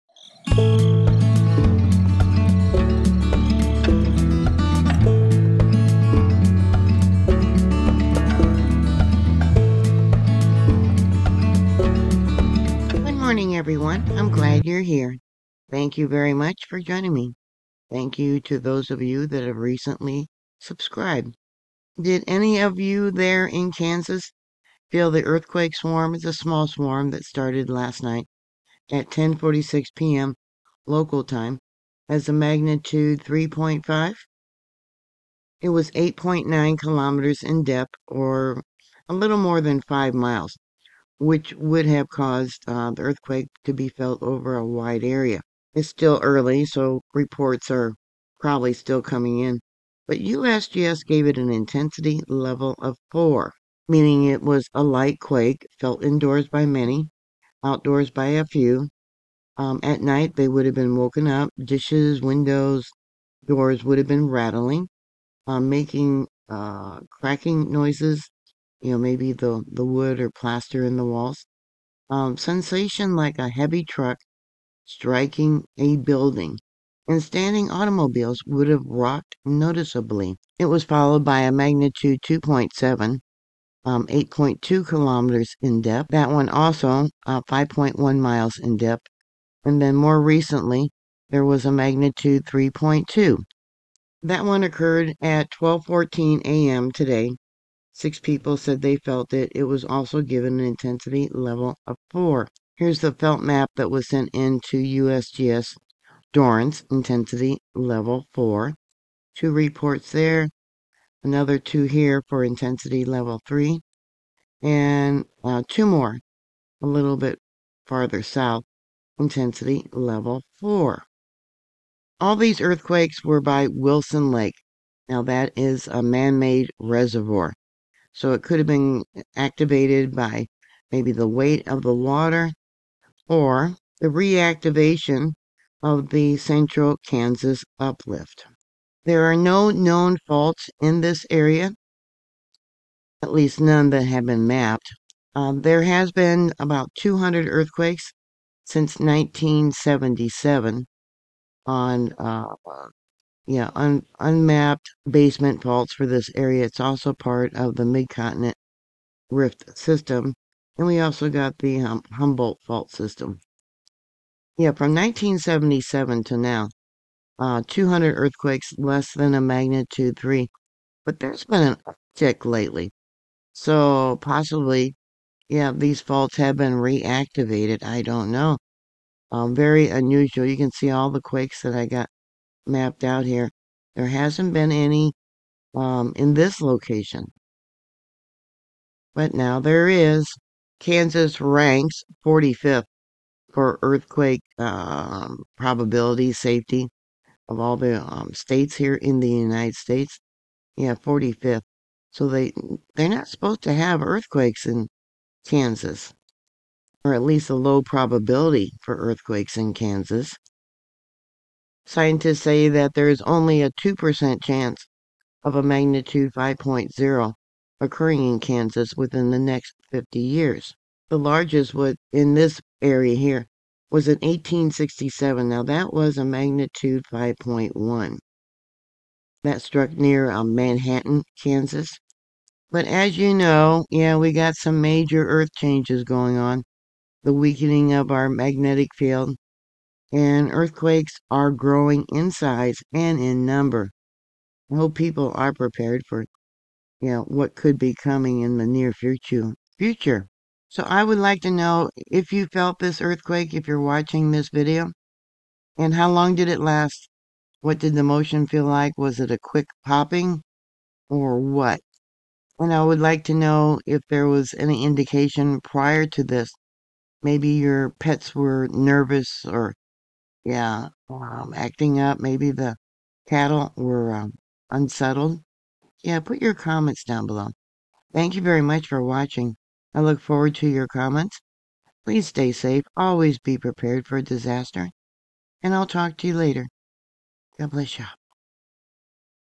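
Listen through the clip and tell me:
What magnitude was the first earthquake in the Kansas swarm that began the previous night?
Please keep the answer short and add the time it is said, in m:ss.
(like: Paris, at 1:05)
3.5, at 0:32.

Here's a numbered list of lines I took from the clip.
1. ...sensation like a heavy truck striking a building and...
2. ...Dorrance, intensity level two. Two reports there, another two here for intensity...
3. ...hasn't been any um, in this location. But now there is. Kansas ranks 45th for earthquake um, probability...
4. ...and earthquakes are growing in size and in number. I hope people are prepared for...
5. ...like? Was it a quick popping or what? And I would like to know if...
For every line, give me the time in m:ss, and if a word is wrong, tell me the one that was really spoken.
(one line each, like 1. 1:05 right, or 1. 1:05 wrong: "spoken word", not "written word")
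1. 1:12 right
2. 1:46 wrong: "four", not "two"
3. 3:04 right
4. 4:00 right
5. 4:18 right.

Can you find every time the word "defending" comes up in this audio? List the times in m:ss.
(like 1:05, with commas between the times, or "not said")
not said.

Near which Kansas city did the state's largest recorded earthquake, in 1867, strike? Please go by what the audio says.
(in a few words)
Manhattan, Kansas.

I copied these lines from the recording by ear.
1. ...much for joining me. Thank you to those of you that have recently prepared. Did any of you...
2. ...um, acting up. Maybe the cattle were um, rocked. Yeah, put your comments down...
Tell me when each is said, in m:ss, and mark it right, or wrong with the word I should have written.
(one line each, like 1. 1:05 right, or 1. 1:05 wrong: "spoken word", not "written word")
1. 0:16 wrong: "subscribed", not "prepared"
2. 4:31 wrong: "unsettled", not "rocked".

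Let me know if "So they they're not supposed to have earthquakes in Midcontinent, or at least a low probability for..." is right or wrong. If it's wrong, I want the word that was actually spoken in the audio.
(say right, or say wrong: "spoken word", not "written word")
wrong: "Kansas", not "Midcontinent".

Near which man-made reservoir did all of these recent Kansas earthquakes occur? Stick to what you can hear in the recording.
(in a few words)
Wilson Lake.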